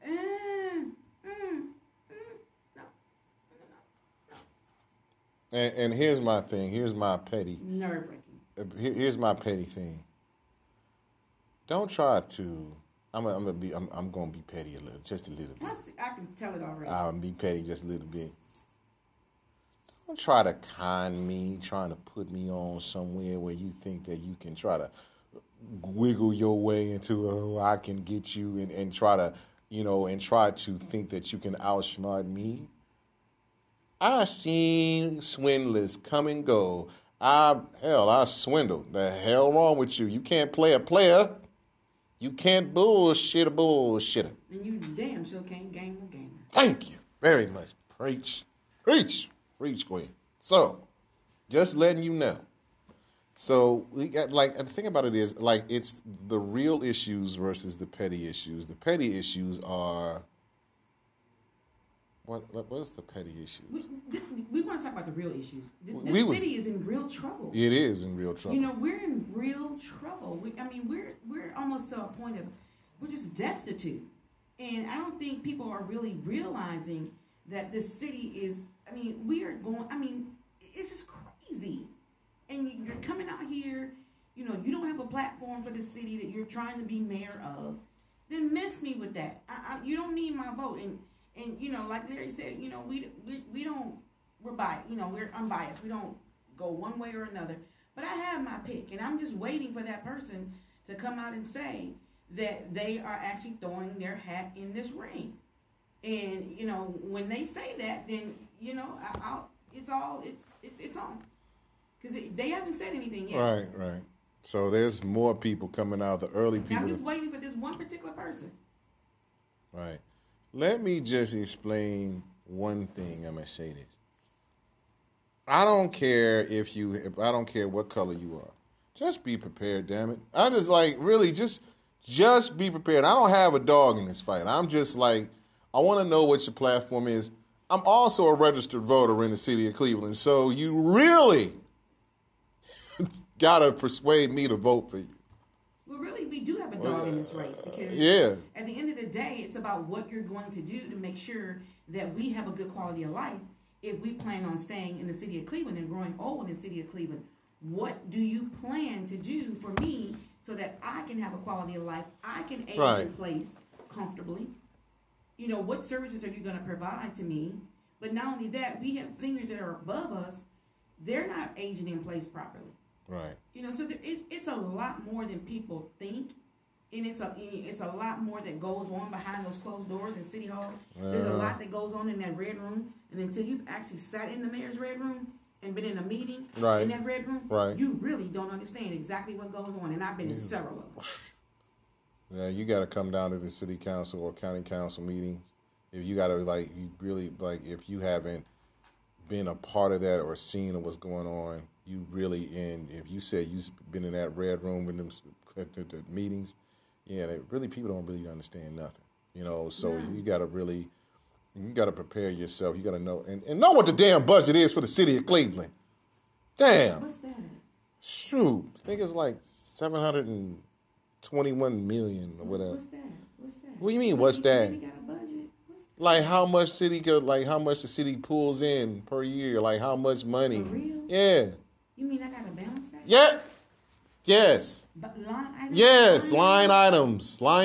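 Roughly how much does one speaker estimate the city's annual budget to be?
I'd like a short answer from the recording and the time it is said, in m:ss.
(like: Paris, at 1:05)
$721 million, at 3:39.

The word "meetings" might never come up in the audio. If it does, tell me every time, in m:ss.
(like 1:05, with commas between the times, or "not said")
3:06, 3:15, 3:26.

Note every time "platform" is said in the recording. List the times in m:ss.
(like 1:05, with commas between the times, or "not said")
1:25, 2:16.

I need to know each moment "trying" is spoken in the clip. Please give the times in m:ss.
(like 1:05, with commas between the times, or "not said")
0:21, 1:26.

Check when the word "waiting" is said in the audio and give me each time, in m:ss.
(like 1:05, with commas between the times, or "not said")
1:39, 1:57.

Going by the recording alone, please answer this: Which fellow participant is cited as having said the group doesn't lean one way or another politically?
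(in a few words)
Larry.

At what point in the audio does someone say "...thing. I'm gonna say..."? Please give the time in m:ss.
2:02.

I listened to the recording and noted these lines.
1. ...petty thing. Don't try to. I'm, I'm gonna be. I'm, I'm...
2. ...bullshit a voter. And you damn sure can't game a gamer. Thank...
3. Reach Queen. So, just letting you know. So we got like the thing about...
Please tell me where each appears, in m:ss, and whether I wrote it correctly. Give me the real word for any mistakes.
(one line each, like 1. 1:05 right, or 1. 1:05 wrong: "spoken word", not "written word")
1. 0:09 right
2. 0:42 wrong: "bullshitter", not "voter"
3. 0:49 right.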